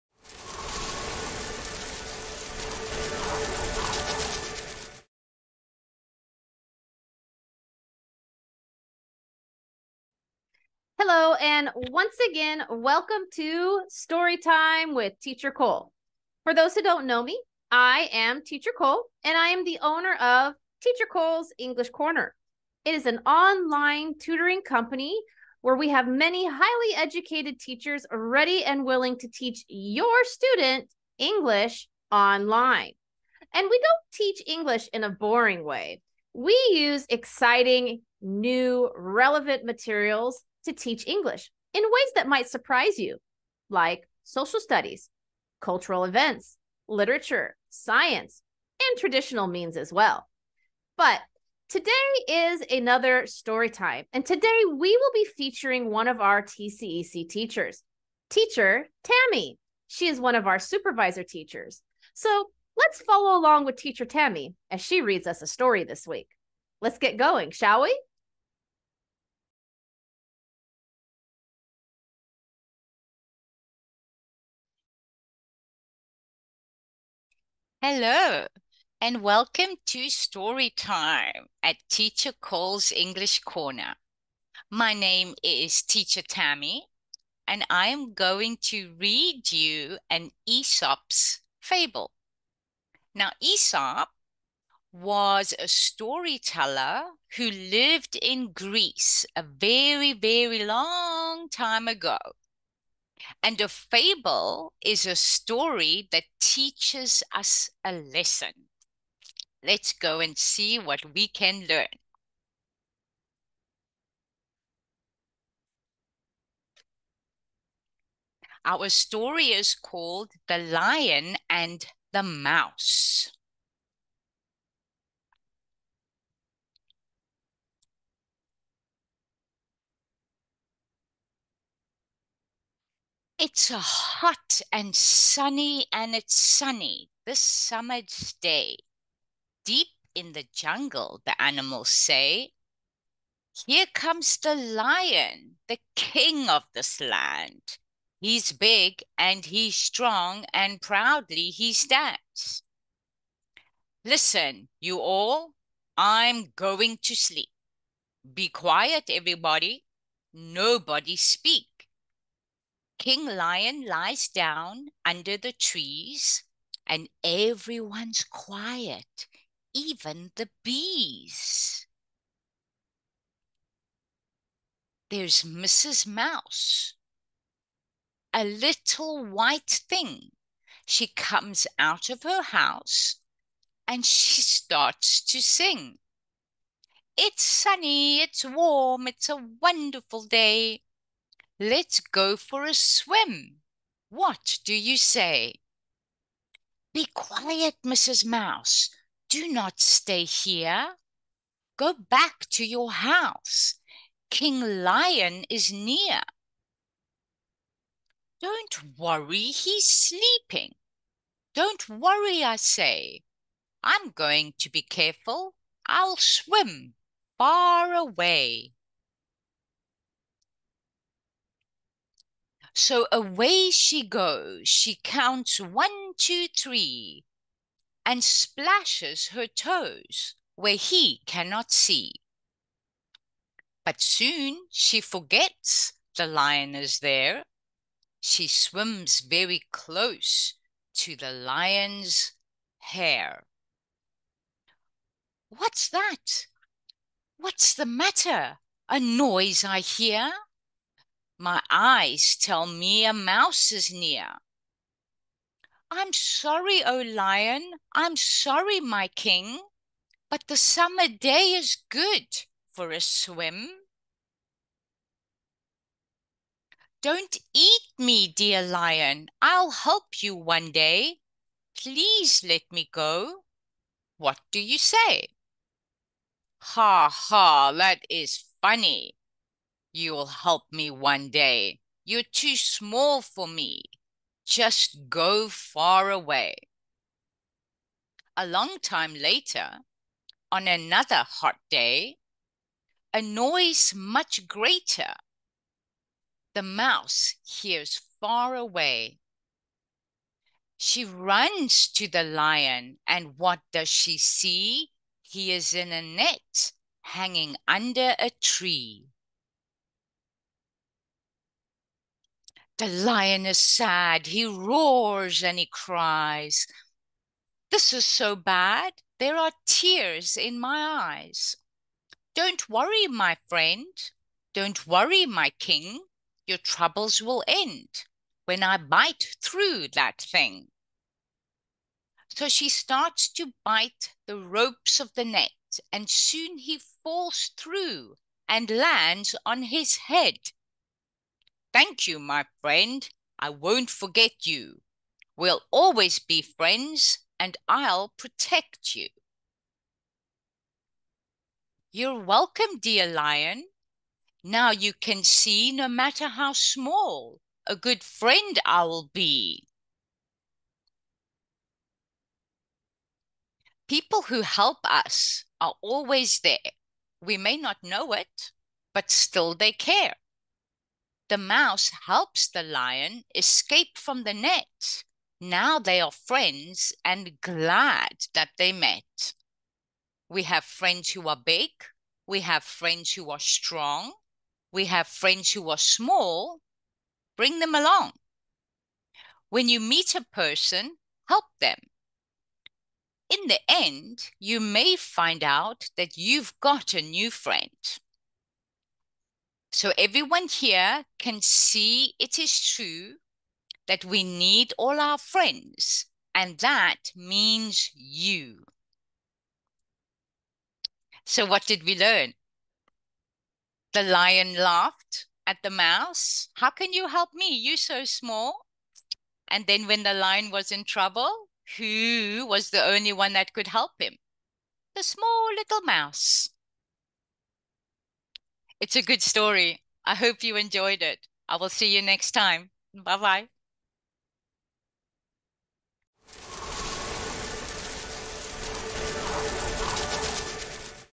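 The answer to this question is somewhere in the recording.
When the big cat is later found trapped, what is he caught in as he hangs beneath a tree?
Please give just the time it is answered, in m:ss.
5:05.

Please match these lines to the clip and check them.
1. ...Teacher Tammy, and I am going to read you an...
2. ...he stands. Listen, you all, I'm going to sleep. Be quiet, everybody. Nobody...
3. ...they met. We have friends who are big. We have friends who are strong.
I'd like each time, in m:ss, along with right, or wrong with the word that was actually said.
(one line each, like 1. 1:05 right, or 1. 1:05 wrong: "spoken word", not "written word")
1. 1:25 right
2. 2:31 right
3. 6:18 right.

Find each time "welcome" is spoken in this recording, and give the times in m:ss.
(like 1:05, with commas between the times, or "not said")
0:12, 1:19, 5:52.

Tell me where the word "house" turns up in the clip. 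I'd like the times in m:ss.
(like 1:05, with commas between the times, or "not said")
3:02, 3:22.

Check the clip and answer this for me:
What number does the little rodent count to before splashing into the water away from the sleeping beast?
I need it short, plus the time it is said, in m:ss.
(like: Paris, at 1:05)
3, at 3:46.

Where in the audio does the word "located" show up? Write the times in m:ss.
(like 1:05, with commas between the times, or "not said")
not said.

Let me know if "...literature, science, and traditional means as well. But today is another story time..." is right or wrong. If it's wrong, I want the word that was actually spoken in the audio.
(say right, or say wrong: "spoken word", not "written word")
right.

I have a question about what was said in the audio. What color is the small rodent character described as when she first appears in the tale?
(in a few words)
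White.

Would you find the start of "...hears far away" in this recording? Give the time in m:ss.
4:57.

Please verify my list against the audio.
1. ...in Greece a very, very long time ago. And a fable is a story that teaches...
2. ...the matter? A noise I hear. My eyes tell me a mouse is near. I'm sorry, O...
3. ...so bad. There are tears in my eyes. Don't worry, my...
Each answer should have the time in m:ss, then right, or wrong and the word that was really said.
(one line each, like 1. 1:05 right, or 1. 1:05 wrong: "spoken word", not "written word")
1. 1:38 right
2. 4:07 right
3. 5:18 right.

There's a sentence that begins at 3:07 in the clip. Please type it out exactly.
It's sunny, it's warm, it's a wonderful day.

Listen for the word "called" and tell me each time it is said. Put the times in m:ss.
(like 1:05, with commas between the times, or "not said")
1:59.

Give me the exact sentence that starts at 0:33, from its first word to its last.
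And we don't teach English in a boring way.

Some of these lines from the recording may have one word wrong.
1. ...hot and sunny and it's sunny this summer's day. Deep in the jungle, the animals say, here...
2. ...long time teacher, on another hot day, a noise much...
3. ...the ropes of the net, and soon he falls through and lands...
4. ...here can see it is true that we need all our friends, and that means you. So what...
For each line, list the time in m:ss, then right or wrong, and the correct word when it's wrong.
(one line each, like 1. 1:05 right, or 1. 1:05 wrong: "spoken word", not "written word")
1. 2:13 right
2. 4:48 wrong: "later", not "teacher"
3. 5:34 right
4. 6:40 right.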